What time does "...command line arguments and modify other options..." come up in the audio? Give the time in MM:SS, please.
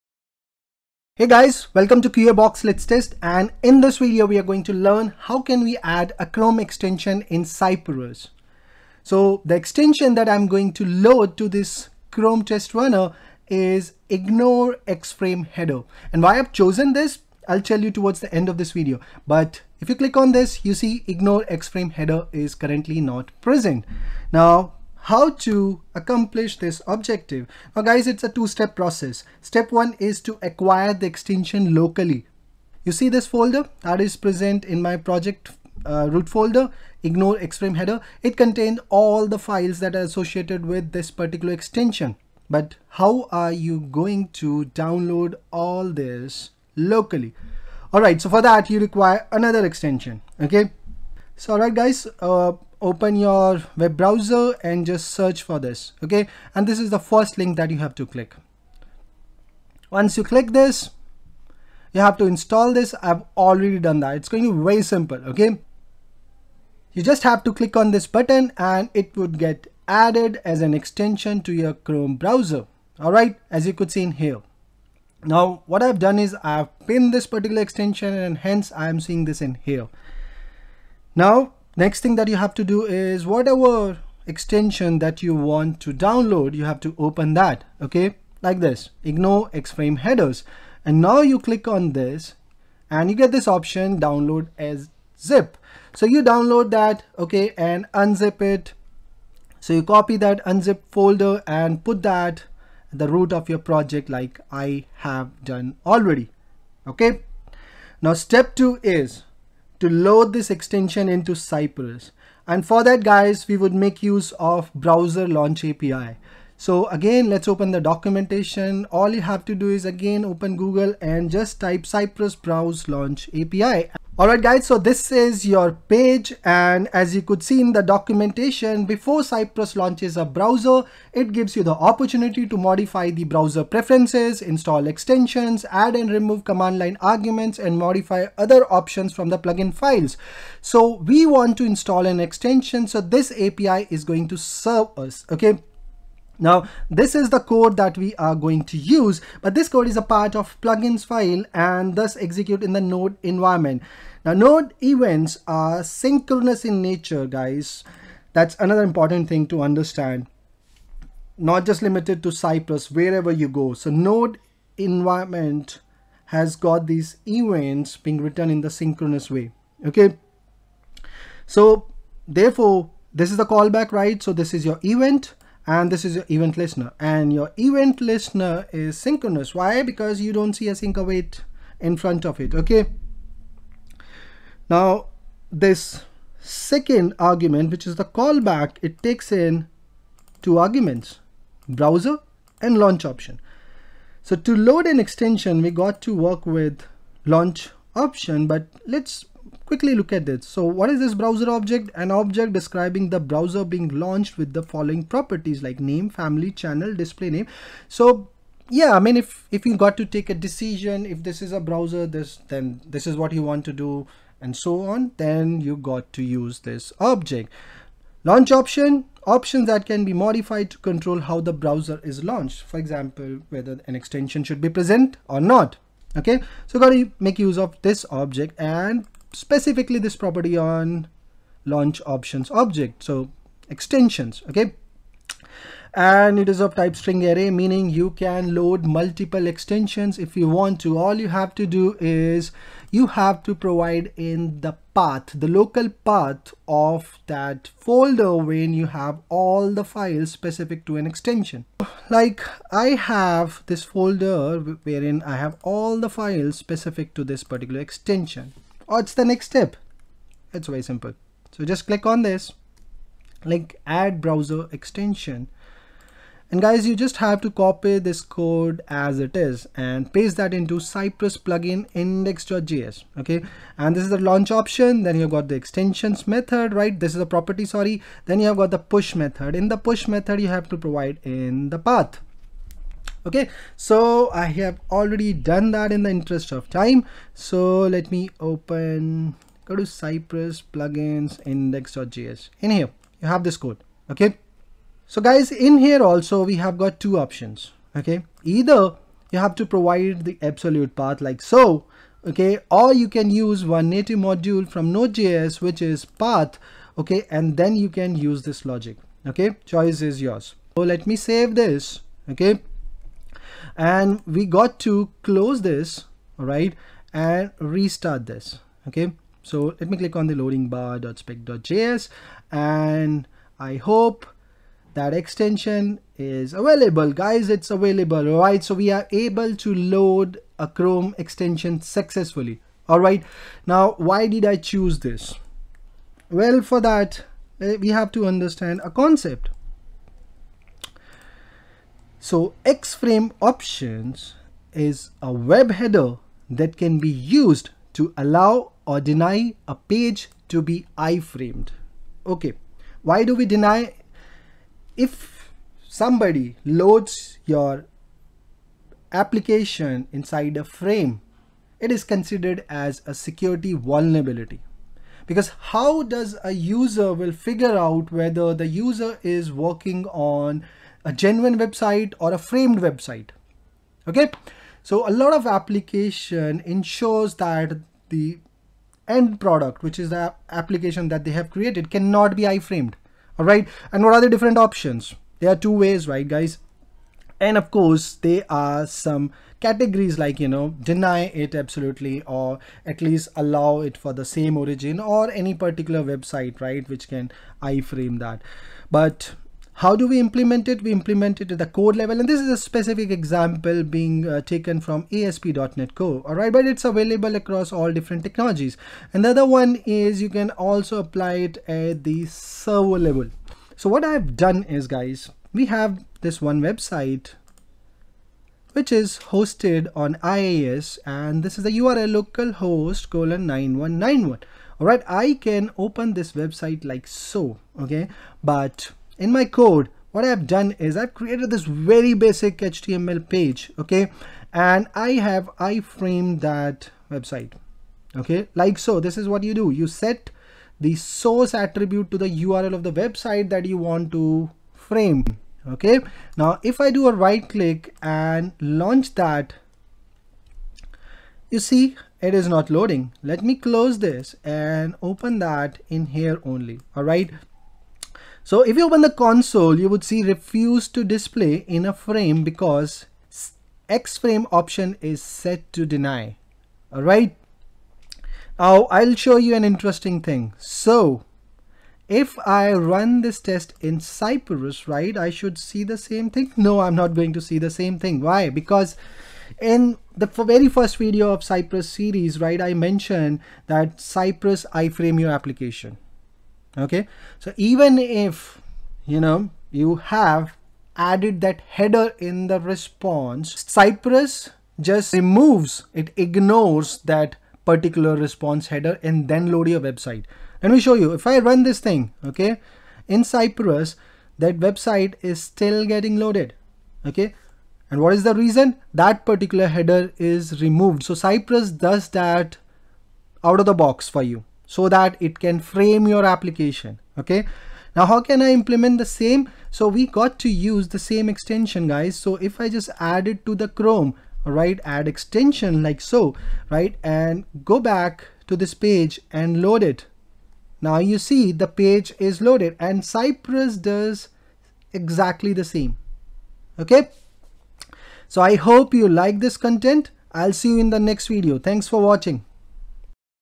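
02:16.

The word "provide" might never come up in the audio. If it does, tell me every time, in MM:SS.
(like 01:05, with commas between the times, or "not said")
04:03, 04:40, 04:59.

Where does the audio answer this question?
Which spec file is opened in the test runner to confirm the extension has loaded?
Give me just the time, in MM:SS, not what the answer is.
05:20.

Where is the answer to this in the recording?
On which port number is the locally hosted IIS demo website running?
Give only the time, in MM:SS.
07:03.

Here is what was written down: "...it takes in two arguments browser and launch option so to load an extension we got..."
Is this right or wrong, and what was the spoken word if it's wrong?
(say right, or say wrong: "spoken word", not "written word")
right.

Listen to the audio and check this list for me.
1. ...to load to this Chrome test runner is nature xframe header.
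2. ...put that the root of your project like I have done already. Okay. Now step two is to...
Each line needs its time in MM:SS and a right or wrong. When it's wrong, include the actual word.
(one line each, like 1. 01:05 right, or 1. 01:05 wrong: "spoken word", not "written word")
1. 00:10 wrong: "ignore", not "nature"
2. 01:41 right.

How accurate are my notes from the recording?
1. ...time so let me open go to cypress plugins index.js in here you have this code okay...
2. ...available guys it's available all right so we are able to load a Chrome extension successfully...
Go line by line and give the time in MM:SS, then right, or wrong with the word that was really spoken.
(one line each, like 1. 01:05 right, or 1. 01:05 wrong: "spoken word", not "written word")
1. 04:46 right
2. 05:26 right.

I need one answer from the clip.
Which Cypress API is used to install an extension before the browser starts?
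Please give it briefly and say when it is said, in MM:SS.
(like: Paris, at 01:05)
Browser launch API, at 01:54.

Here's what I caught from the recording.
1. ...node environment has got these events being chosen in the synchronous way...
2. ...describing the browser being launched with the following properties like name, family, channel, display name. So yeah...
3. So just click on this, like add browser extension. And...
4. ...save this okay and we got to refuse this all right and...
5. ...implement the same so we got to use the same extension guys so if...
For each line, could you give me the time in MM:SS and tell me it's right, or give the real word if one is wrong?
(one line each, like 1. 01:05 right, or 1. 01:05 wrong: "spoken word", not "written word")
1. 02:43 wrong: "written", not "chosen"
2. 03:22 right
3. 04:21 right
4. 05:11 wrong: "close", not "refuse"
5. 08:38 right.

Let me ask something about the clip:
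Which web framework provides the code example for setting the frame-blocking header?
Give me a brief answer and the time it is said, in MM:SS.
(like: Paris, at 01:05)
ASP.NET Core, at 06:45.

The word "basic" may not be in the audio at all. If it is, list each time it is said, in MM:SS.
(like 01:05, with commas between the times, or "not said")
07:12.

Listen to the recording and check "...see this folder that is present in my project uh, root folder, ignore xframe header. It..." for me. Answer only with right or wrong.
right.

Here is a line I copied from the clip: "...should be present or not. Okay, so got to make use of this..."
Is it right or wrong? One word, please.
right.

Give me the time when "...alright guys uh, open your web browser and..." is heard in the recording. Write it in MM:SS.
00:51.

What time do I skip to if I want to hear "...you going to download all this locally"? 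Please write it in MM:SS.
00:43.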